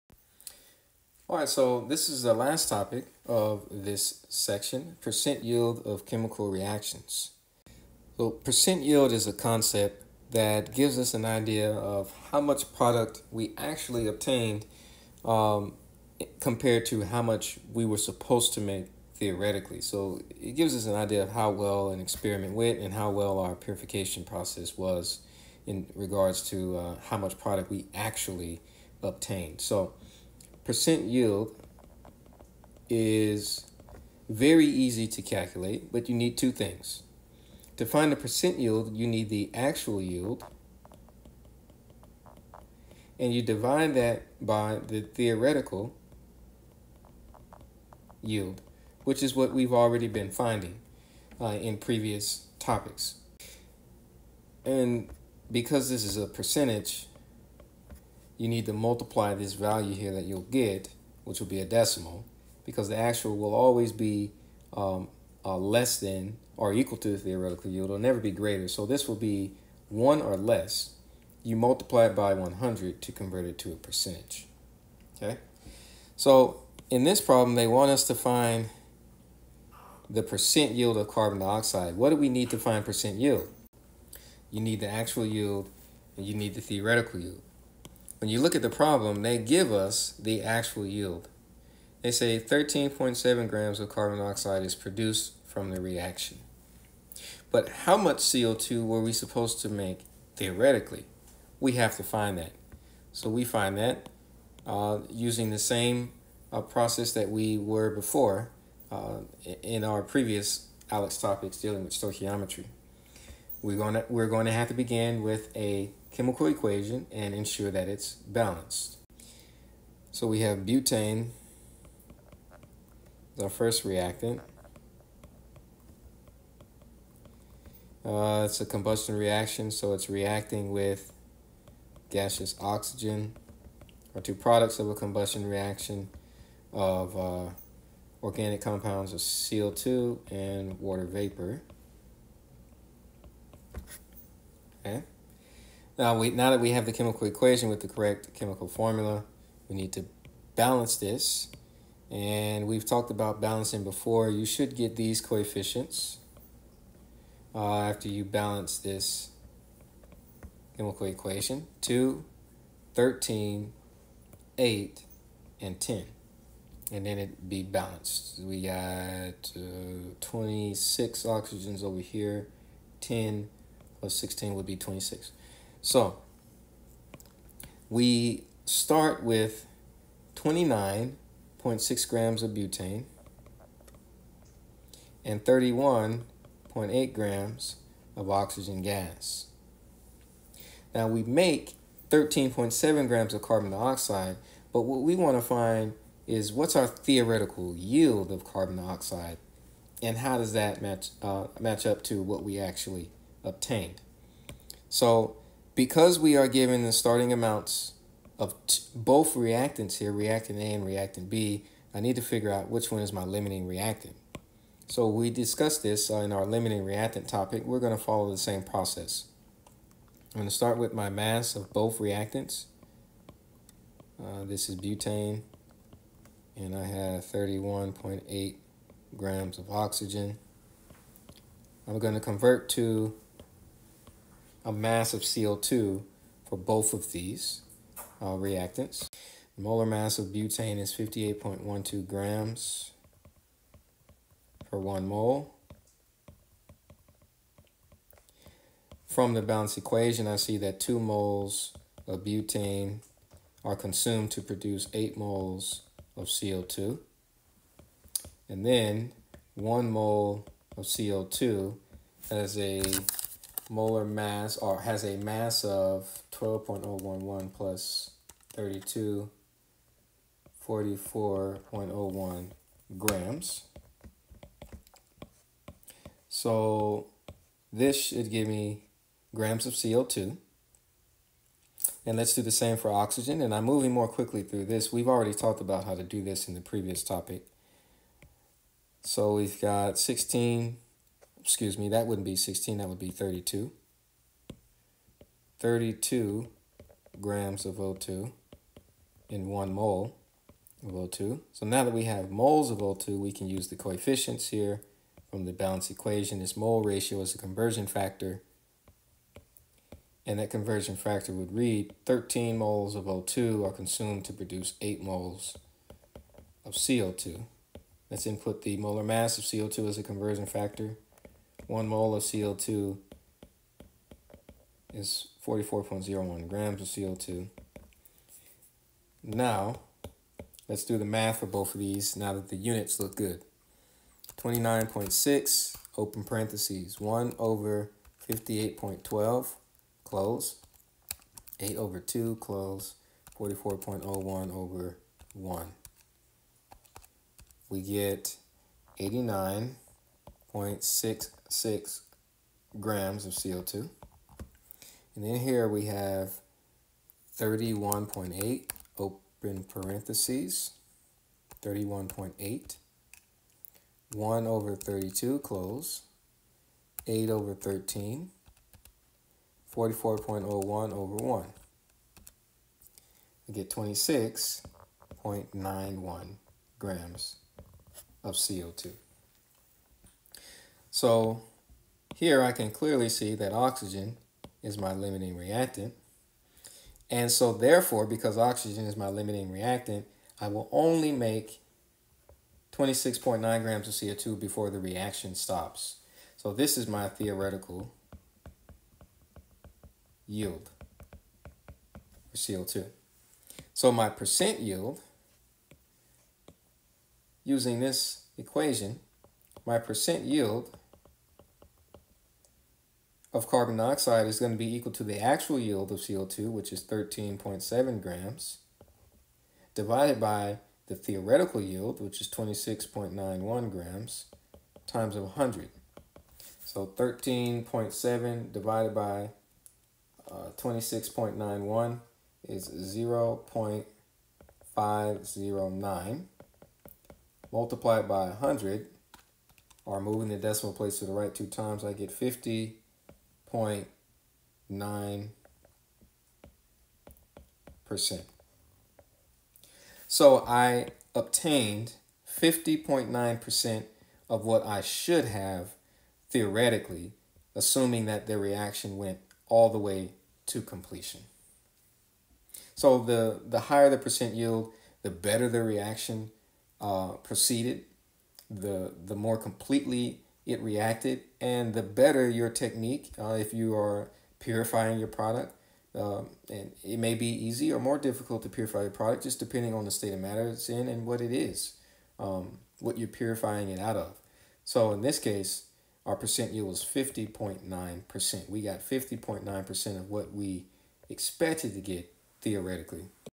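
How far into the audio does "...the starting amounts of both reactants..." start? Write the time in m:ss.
3:26.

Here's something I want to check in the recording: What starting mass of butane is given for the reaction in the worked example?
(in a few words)
29.6 grams.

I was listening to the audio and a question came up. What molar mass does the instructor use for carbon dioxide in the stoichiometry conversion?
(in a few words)
44.01 grams.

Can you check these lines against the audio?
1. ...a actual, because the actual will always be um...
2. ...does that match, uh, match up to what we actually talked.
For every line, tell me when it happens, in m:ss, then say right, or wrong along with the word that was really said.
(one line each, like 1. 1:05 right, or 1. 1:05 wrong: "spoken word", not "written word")
1. 1:01 wrong: "decimal", not "actual"
2. 3:20 wrong: "obtained", not "talked".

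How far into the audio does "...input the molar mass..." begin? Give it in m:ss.
5:18.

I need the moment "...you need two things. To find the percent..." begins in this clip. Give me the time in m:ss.
0:36.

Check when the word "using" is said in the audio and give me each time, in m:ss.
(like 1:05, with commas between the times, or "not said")
1:45, 6:47.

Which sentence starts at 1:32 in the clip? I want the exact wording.
They say 13.7 grams of carbon dioxide is produced from the reaction.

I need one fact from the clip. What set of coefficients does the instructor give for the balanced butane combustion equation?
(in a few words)
2, 13, 8, and 10.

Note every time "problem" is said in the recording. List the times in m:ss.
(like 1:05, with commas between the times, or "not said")
1:17, 1:28.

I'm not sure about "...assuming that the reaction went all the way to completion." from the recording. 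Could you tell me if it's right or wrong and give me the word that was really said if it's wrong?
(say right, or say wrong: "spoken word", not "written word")
right.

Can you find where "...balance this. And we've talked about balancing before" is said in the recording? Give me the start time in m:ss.
2:30.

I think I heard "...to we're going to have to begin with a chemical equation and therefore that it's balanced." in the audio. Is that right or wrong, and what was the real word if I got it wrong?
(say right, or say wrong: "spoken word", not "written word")
wrong: "ensure", not "therefore".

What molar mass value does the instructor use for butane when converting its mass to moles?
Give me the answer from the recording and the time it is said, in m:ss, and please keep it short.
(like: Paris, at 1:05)
58.12 grams per mole, at 4:00.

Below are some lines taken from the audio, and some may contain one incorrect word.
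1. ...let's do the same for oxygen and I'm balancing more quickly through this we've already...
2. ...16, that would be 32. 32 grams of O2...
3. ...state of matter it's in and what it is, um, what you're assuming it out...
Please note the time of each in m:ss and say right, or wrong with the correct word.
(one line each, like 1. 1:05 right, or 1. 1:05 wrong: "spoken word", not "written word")
1. 4:42 wrong: "moving", not "balancing"
2. 4:52 right
3. 7:59 wrong: "purifying", not "assuming".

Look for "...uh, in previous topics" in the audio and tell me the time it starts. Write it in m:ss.
0:51.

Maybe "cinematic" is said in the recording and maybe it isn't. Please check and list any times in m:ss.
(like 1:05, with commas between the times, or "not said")
not said.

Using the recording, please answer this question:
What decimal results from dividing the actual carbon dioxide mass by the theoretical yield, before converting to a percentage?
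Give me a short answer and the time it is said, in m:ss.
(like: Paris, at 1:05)
0.509, at 7:14.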